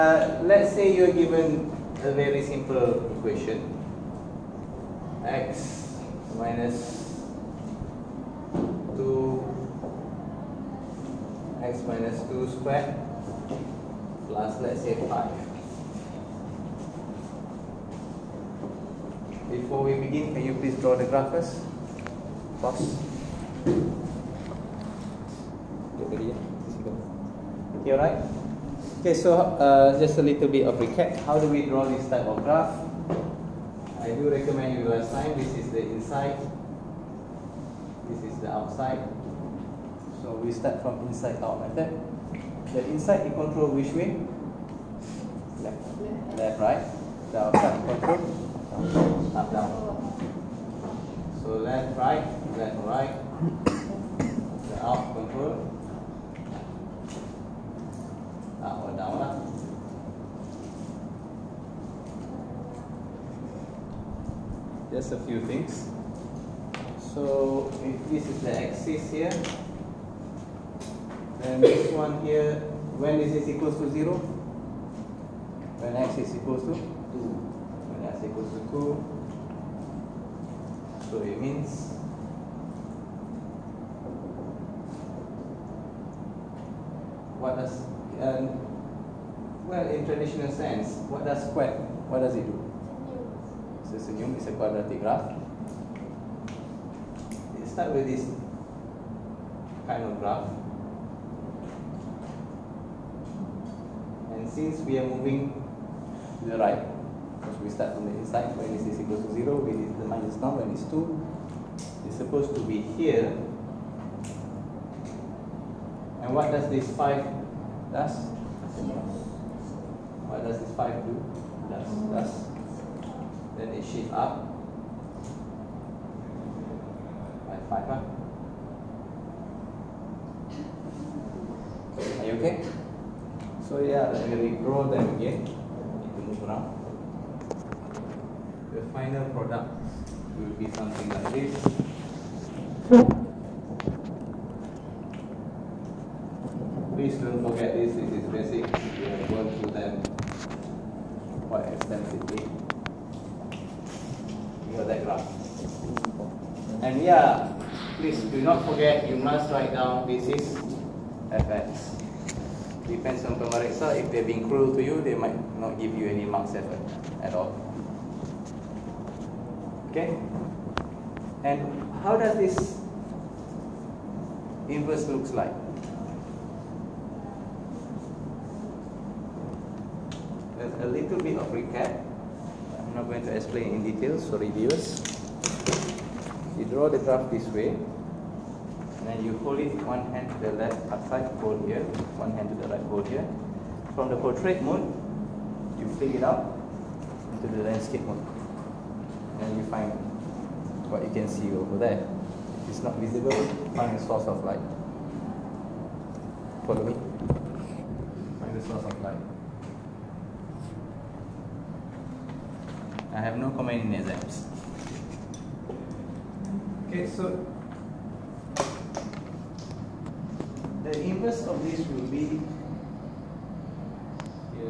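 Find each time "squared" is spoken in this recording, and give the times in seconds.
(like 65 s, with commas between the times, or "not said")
12 s.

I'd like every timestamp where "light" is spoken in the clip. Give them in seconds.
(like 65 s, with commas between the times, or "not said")
204 s, 209 s.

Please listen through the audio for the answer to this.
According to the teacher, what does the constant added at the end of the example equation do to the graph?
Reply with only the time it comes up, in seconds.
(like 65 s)
123 s.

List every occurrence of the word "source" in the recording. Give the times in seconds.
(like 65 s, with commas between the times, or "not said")
204 s, 208 s.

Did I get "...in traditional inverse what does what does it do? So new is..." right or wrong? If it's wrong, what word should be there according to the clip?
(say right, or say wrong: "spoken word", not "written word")
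wrong: "sense", not "inverse".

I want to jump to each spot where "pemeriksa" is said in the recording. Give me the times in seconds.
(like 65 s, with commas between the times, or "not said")
163 s.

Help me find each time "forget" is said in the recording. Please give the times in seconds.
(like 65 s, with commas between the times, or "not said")
147 s, 158 s.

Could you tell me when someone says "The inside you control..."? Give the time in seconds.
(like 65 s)
42 s.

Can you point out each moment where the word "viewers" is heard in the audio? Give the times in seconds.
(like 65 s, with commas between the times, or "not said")
184 s.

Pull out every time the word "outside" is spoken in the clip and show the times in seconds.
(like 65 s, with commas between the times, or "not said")
38 s, 47 s, 190 s.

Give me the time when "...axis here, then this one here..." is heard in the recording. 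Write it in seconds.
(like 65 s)
68 s.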